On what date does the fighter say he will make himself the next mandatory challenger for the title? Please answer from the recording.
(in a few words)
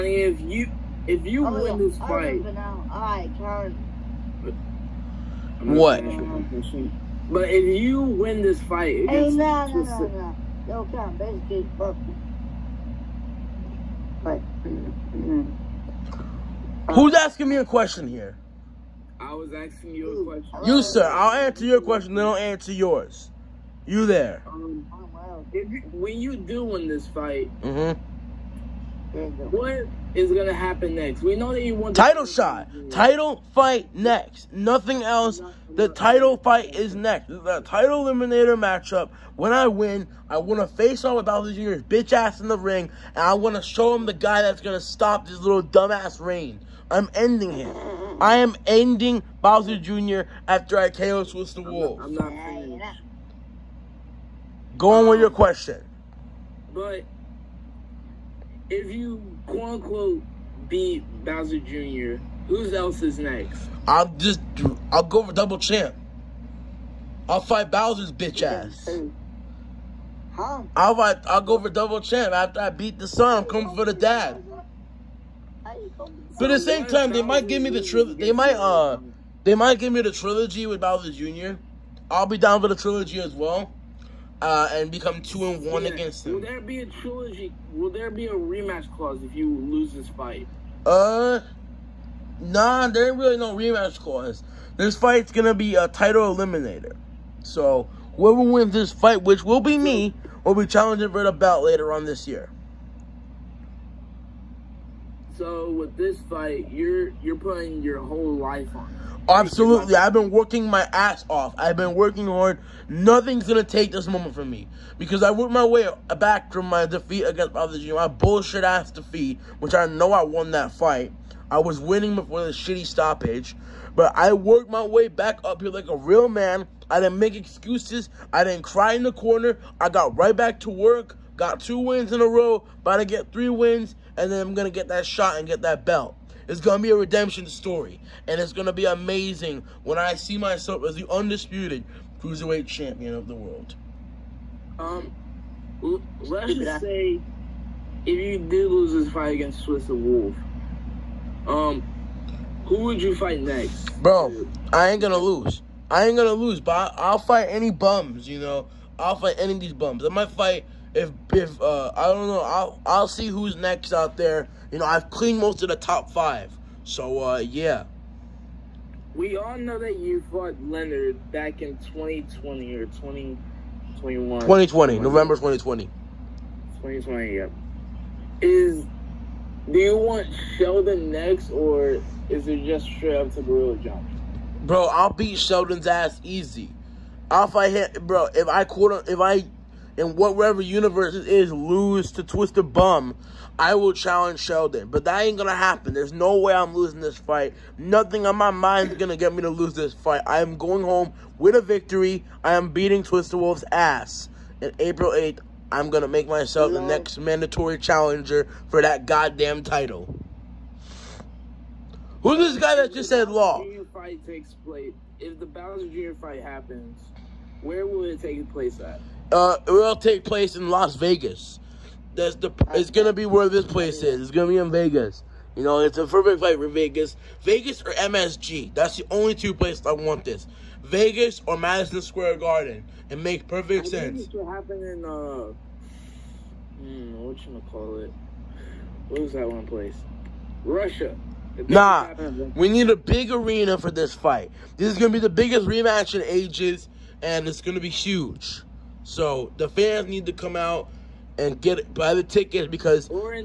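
April 8th.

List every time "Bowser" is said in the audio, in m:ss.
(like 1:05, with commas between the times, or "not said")
0:41, 0:49, 1:01, 1:07, 1:20, 3:35.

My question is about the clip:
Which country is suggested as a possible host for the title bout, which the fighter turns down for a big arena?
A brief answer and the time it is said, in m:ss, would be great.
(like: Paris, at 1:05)
Russia, at 4:00.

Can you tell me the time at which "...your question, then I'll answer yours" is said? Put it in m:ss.
0:21.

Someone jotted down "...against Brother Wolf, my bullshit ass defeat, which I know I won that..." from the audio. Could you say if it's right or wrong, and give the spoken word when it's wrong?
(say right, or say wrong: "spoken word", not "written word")
wrong: "Junior", not "Wolf".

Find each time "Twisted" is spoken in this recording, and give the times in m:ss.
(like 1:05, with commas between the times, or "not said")
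3:12, 3:23.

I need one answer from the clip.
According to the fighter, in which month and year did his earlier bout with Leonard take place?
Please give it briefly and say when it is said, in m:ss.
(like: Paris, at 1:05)
November 2020, at 2:54.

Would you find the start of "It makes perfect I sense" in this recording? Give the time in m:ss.
3:53.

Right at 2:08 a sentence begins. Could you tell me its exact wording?
I didn't cry in the corner.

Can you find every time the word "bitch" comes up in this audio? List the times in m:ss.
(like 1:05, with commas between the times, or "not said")
0:41, 1:08.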